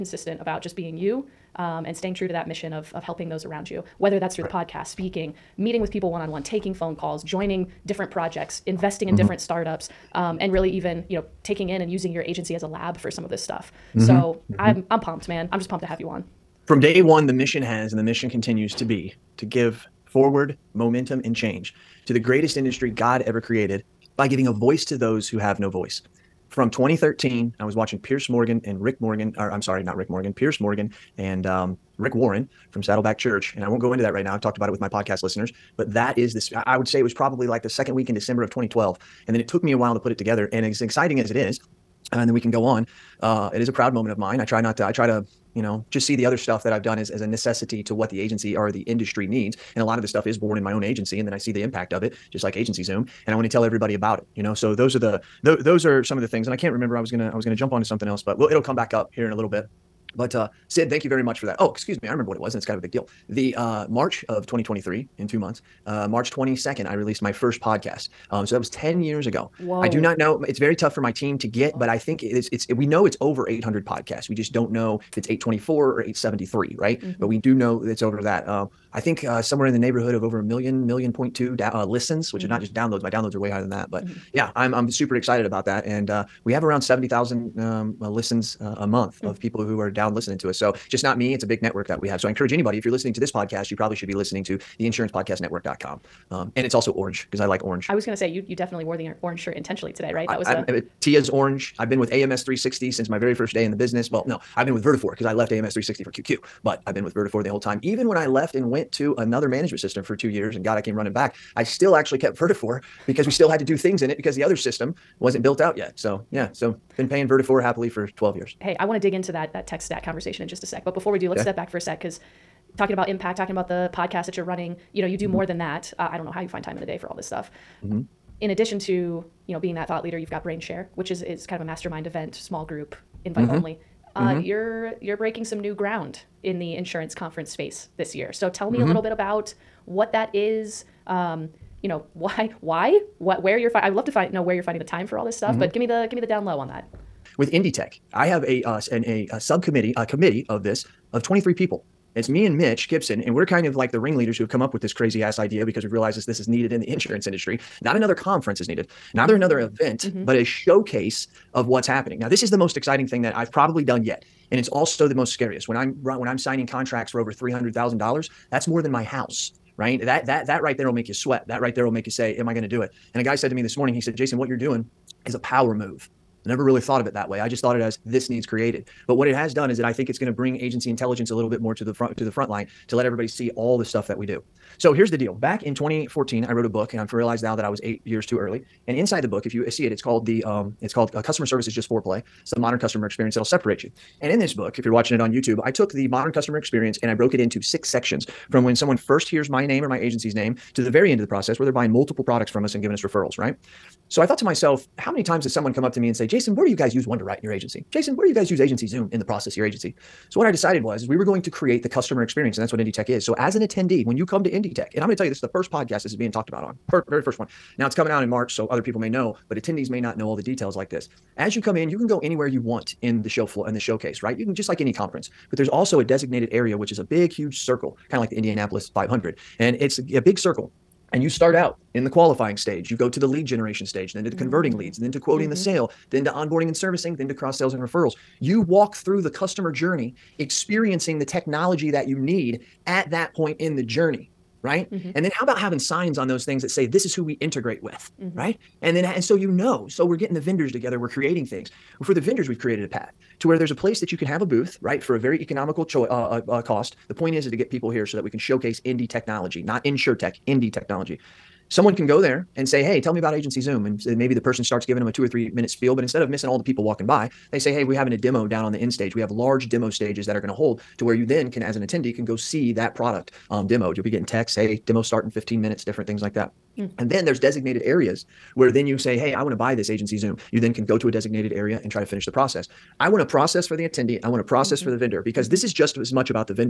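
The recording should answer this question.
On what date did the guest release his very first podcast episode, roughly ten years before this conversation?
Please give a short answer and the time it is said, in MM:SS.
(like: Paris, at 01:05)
March 22nd, at 01:06.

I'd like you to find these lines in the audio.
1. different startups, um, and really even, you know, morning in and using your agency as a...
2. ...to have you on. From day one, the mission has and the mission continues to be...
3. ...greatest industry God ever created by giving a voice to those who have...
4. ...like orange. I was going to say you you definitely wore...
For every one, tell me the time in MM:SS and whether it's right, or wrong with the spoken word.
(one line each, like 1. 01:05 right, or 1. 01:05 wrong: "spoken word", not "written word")
1. 00:09 wrong: "taking", not "morning"
2. 00:15 right
3. 00:22 right
4. 01:37 right.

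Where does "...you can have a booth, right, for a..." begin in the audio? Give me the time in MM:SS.
04:14.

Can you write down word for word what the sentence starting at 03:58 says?
You walk through the customer journey experiencing the technology that you need at that point in the journey, right?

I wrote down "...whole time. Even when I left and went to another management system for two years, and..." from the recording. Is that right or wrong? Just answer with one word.
right.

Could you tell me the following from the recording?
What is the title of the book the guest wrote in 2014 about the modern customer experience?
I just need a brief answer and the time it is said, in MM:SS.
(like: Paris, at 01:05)
Customer Service Is Just Foreplay, at 03:11.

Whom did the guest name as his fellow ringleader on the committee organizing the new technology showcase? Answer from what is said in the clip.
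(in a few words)
Mitch Gibson.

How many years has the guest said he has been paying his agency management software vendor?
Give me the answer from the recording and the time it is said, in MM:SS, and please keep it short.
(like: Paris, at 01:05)
12 years, at 01:58.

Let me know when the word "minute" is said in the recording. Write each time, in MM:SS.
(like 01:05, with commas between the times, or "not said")
04:25, 04:35.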